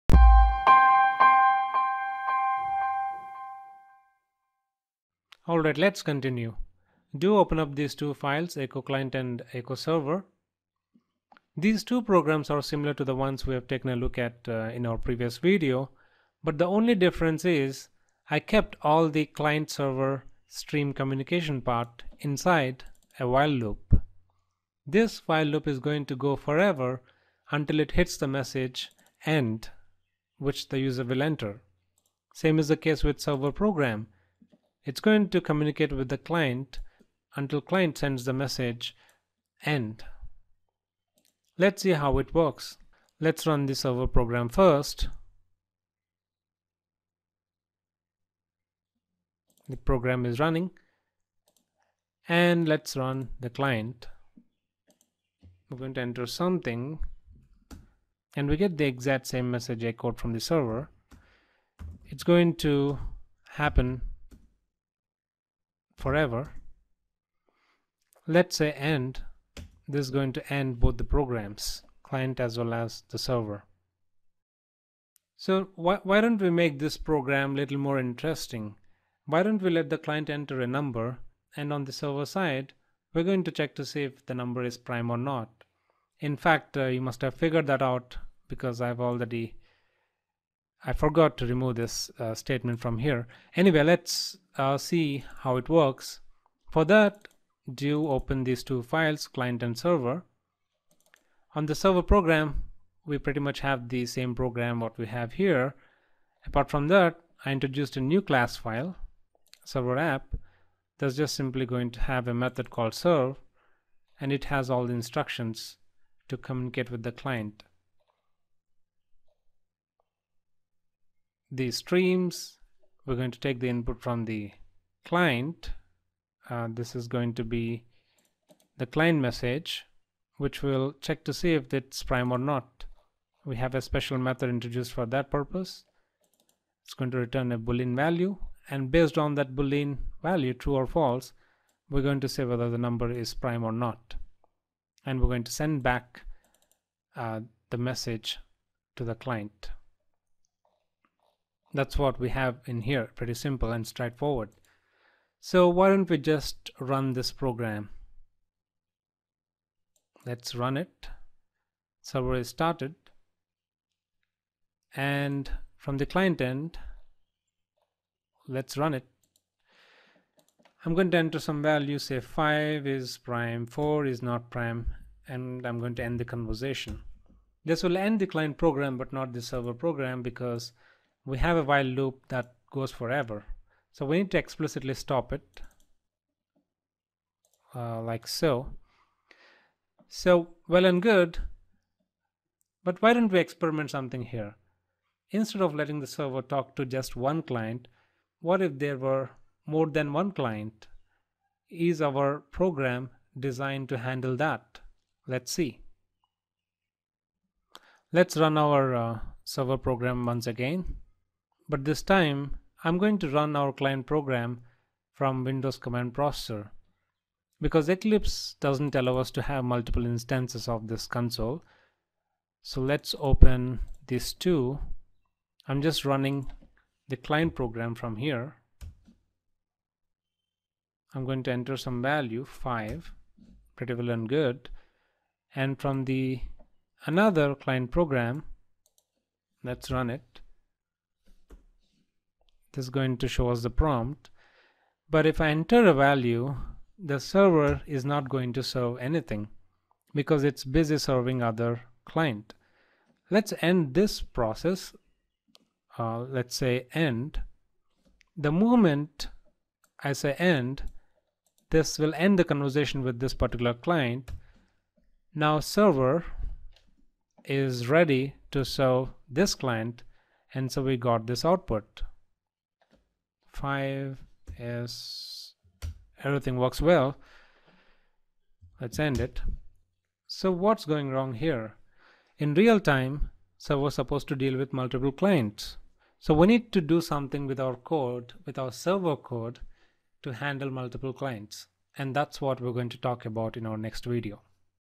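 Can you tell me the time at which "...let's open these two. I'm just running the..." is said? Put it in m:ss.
3:42.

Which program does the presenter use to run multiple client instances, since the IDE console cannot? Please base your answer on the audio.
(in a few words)
Windows Command Processor.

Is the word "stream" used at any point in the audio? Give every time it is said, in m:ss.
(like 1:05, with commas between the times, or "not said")
0:20, 2:01.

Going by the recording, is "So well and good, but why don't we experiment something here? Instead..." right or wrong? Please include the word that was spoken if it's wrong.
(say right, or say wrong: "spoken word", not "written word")
right.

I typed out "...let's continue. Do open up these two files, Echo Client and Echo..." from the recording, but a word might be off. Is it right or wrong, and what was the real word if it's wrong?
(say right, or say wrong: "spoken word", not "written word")
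right.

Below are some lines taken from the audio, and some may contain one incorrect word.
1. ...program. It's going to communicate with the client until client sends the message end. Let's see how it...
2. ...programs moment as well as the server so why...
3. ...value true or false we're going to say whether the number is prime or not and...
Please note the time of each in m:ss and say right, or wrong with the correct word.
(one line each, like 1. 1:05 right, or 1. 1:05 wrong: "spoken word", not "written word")
1. 0:33 right
2. 1:11 wrong: "client", not "moment"
3. 2:20 right.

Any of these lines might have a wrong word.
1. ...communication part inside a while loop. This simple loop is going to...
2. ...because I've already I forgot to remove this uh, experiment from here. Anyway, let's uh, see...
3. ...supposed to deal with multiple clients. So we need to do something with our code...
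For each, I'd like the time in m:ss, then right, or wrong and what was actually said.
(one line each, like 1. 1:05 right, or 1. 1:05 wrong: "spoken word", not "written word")
1. 0:20 wrong: "while", not "simple"
2. 1:28 wrong: "statement", not "experiment"
3. 4:43 right.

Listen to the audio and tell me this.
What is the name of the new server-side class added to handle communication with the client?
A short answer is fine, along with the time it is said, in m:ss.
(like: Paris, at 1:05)
server app, at 1:49.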